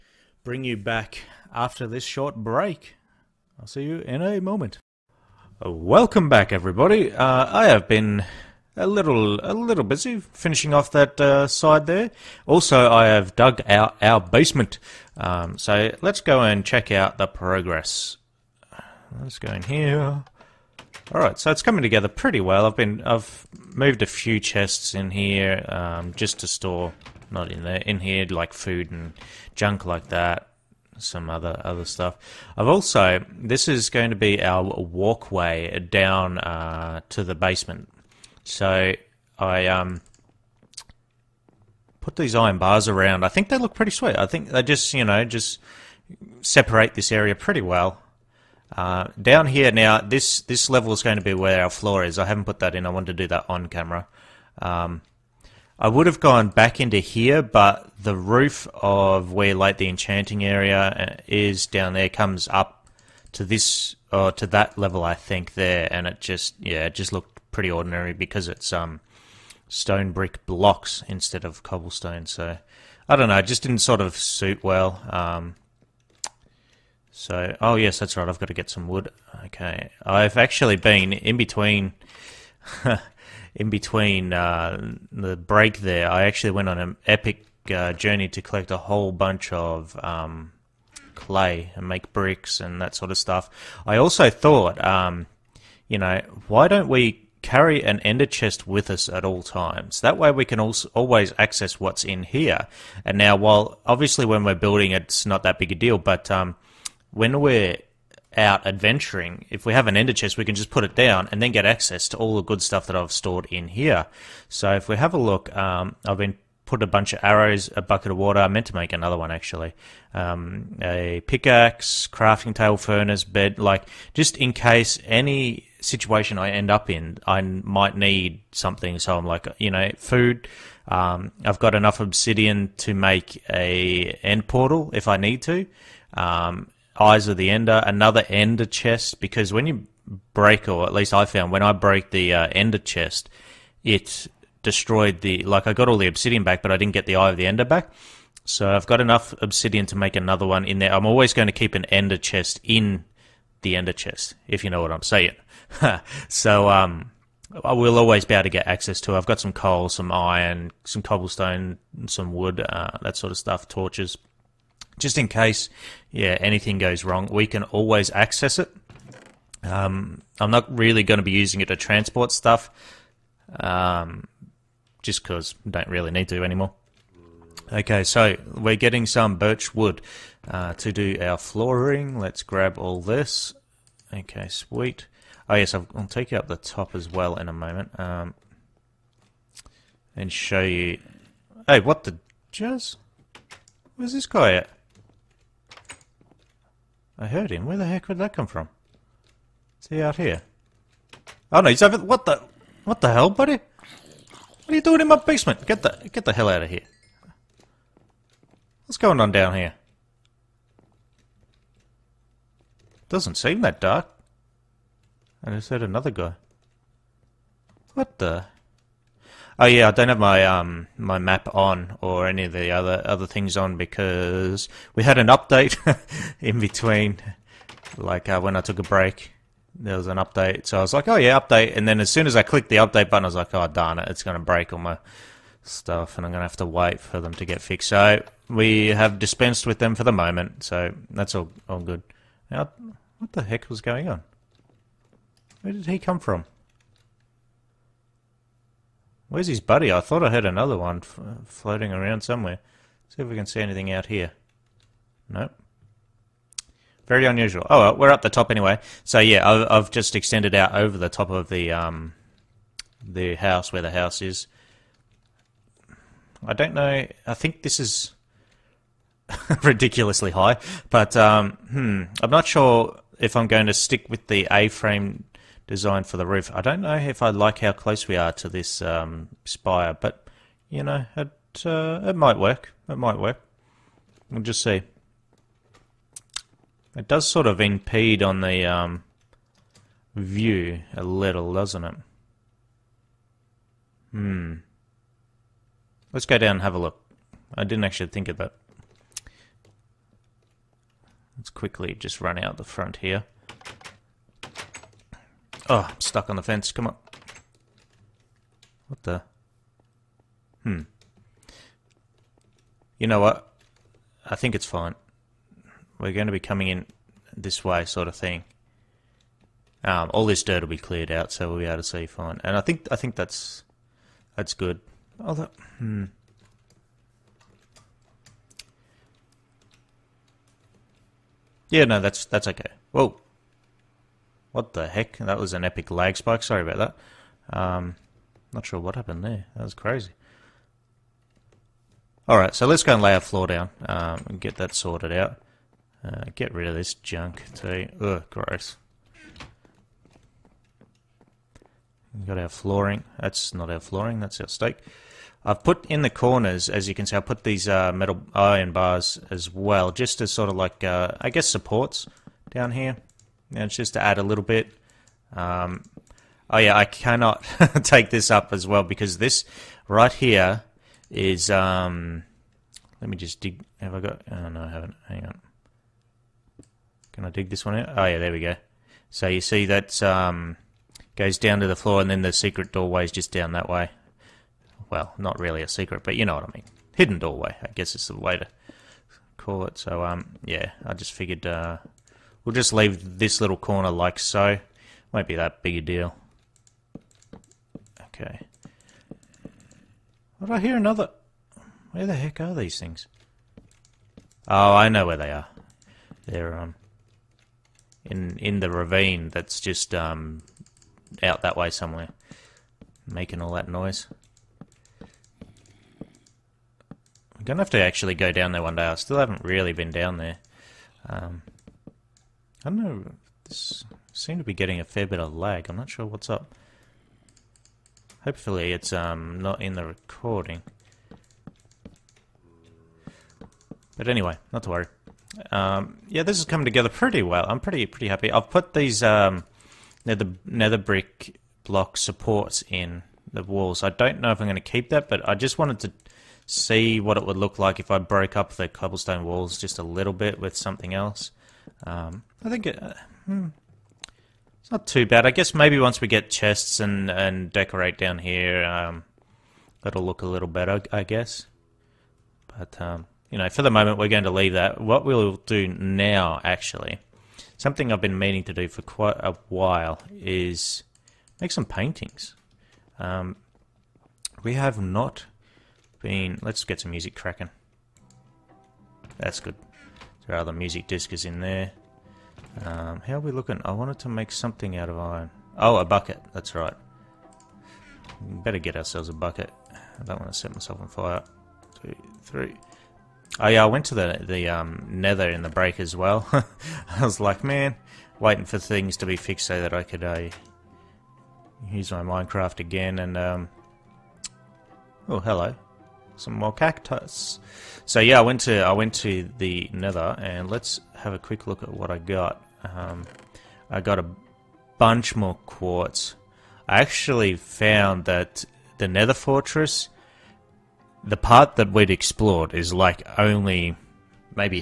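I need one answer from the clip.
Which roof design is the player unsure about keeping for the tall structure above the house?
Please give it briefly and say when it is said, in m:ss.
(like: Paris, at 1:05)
A-frame, at 4:34.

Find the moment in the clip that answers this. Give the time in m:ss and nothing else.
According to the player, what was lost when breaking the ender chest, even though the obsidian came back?
2:27.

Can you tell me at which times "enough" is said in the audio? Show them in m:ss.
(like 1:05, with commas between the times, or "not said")
2:11, 2:29.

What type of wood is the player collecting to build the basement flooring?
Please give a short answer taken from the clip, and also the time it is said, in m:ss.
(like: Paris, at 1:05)
Birch, at 2:59.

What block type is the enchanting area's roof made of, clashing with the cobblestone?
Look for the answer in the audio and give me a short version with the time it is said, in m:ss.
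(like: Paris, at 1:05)
Stone brick blocks, at 1:09.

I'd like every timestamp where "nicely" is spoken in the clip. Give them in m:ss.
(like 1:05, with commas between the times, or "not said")
not said.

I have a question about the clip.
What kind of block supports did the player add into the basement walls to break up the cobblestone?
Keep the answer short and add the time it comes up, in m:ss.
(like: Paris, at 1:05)
Nether brick, at 7:20.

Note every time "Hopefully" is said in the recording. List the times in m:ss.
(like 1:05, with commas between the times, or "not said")
7:08.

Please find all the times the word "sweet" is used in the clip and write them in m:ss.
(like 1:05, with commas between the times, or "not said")
0:43, 3:04.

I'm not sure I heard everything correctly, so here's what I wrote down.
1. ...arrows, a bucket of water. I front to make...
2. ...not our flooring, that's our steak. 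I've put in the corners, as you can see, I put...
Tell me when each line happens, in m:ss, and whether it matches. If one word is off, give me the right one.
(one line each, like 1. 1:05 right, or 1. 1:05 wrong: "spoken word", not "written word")
1. 1:57 wrong: "meant", not "front"
2. 5:53 right.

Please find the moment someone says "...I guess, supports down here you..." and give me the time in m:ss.
6:01.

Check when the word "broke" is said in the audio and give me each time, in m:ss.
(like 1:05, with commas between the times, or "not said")
2:21, 7:27.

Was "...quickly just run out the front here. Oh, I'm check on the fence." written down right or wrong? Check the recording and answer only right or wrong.
wrong.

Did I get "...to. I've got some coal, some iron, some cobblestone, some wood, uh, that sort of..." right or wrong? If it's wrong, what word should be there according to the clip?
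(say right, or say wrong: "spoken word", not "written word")
right.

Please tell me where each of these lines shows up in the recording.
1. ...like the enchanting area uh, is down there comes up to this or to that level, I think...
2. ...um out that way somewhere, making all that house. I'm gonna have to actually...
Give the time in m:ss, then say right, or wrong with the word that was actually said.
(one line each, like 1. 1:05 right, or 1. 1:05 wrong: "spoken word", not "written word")
1. 0:59 right
2. 6:49 wrong: "noise", not "house".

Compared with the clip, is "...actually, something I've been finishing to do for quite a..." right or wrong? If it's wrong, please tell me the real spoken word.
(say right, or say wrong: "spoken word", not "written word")
wrong: "meaning", not "finishing".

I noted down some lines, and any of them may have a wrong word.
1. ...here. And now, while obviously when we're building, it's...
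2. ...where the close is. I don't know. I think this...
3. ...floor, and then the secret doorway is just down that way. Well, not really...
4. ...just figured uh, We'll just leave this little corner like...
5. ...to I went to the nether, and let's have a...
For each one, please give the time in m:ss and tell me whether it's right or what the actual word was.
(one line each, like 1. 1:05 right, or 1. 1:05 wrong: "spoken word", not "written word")
1. 1:42 right
2. 4:23 wrong: "house", not "close"
3. 6:21 right
4. 6:30 right
5. 8:28 right.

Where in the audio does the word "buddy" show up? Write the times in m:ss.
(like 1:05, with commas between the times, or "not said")
3:23, 4:09.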